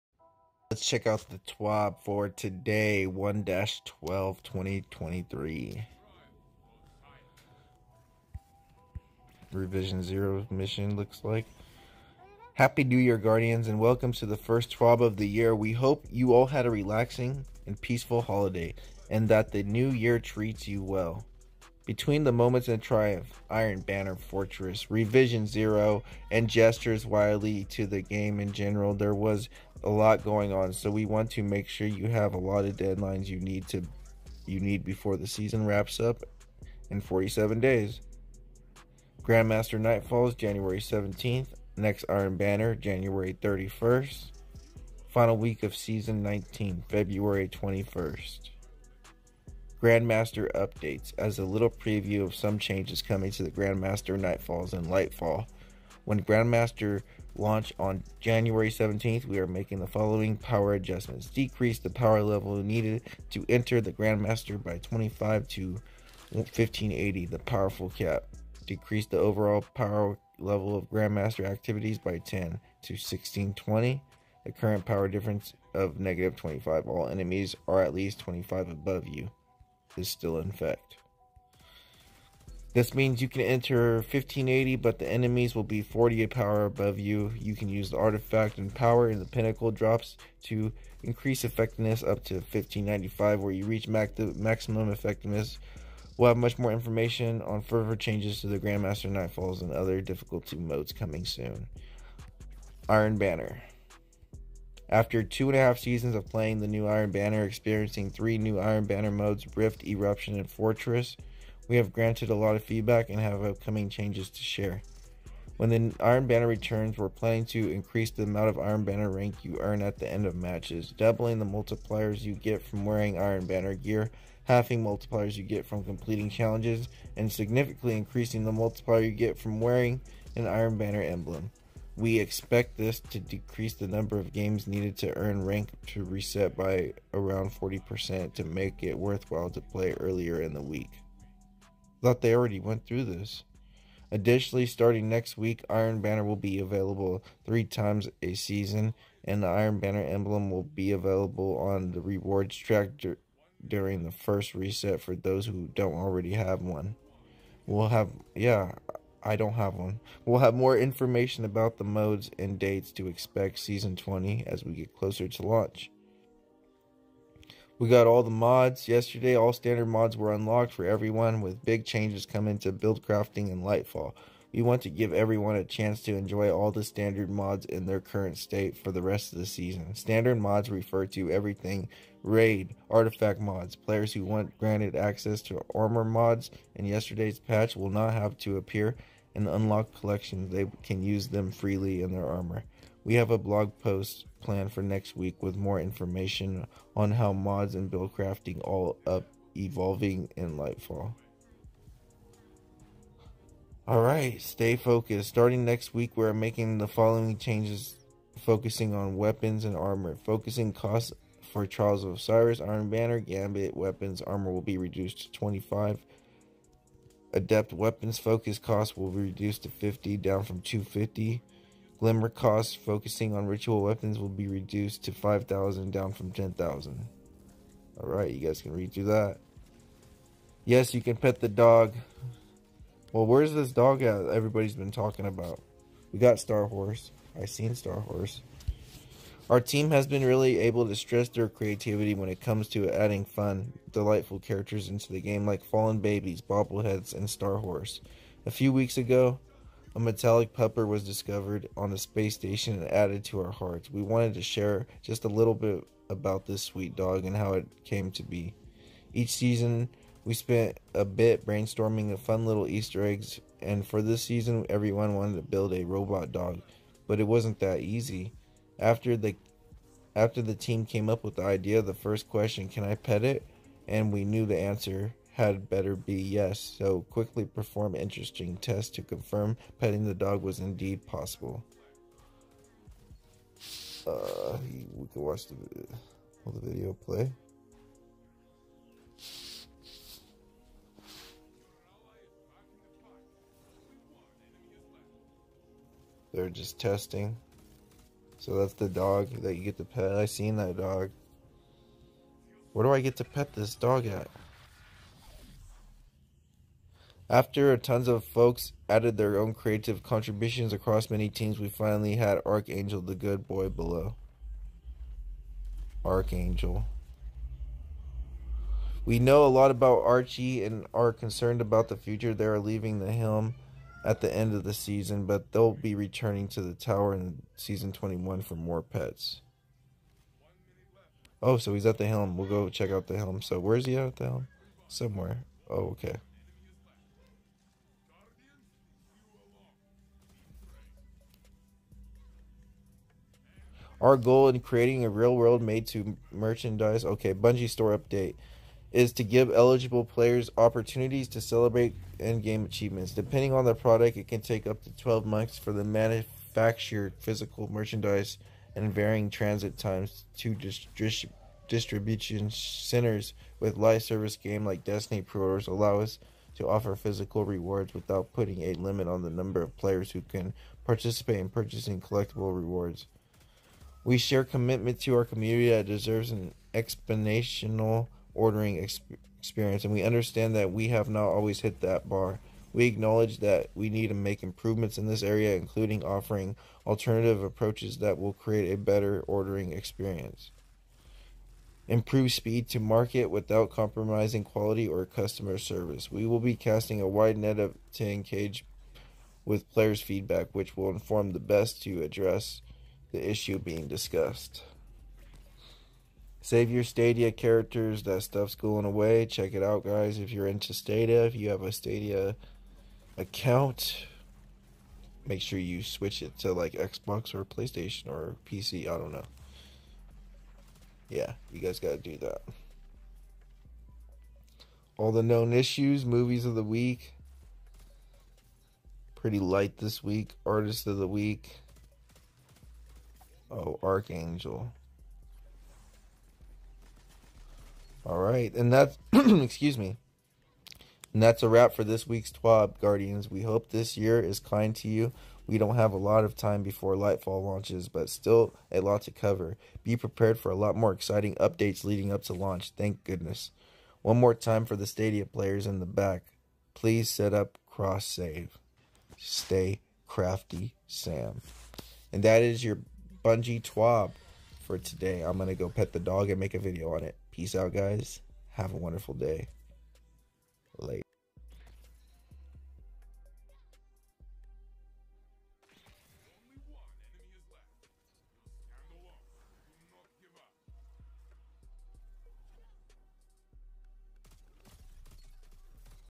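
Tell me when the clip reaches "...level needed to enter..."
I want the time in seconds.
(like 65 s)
62 s.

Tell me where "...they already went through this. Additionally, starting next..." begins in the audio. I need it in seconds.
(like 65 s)
142 s.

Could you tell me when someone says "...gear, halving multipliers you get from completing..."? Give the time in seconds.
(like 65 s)
123 s.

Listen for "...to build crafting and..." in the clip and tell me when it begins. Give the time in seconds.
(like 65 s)
172 s.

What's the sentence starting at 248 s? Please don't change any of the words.
A few weeks ago, a metallic pepper was discovered on the space station and added to our hearts.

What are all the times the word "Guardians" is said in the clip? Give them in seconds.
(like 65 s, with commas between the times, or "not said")
13 s, 442 s.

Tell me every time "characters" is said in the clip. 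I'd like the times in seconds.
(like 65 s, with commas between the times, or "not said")
244 s, 407 s.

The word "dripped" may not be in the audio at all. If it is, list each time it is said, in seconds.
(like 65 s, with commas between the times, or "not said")
not said.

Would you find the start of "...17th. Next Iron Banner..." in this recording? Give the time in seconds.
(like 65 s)
40 s.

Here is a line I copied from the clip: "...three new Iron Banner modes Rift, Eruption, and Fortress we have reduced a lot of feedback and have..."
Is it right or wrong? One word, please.
wrong.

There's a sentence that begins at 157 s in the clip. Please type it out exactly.
We'll have, yeah, I don't have one.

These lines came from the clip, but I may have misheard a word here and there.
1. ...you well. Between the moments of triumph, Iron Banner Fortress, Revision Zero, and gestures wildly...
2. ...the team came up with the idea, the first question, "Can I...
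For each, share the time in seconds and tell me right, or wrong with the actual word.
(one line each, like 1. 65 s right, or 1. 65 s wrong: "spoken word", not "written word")
1. 20 s right
2. 270 s right.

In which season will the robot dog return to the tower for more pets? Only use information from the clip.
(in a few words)
Season 21.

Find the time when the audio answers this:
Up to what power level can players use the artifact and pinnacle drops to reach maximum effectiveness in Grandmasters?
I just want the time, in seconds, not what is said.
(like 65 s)
92 s.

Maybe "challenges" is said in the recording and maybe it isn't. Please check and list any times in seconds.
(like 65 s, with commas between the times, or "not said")
126 s.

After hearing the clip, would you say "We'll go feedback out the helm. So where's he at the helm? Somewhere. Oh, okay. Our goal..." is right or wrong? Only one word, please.
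wrong.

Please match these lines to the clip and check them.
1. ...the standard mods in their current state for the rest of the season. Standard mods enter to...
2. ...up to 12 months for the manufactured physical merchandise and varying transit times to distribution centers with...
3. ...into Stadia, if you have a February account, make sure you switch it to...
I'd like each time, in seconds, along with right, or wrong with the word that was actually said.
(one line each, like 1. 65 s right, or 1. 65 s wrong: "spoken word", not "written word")
1. 176 s wrong: "refer", not "enter"
2. 354 s right
3. 410 s wrong: "Stadia", not "February".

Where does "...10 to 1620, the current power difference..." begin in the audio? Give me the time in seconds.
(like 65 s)
72 s.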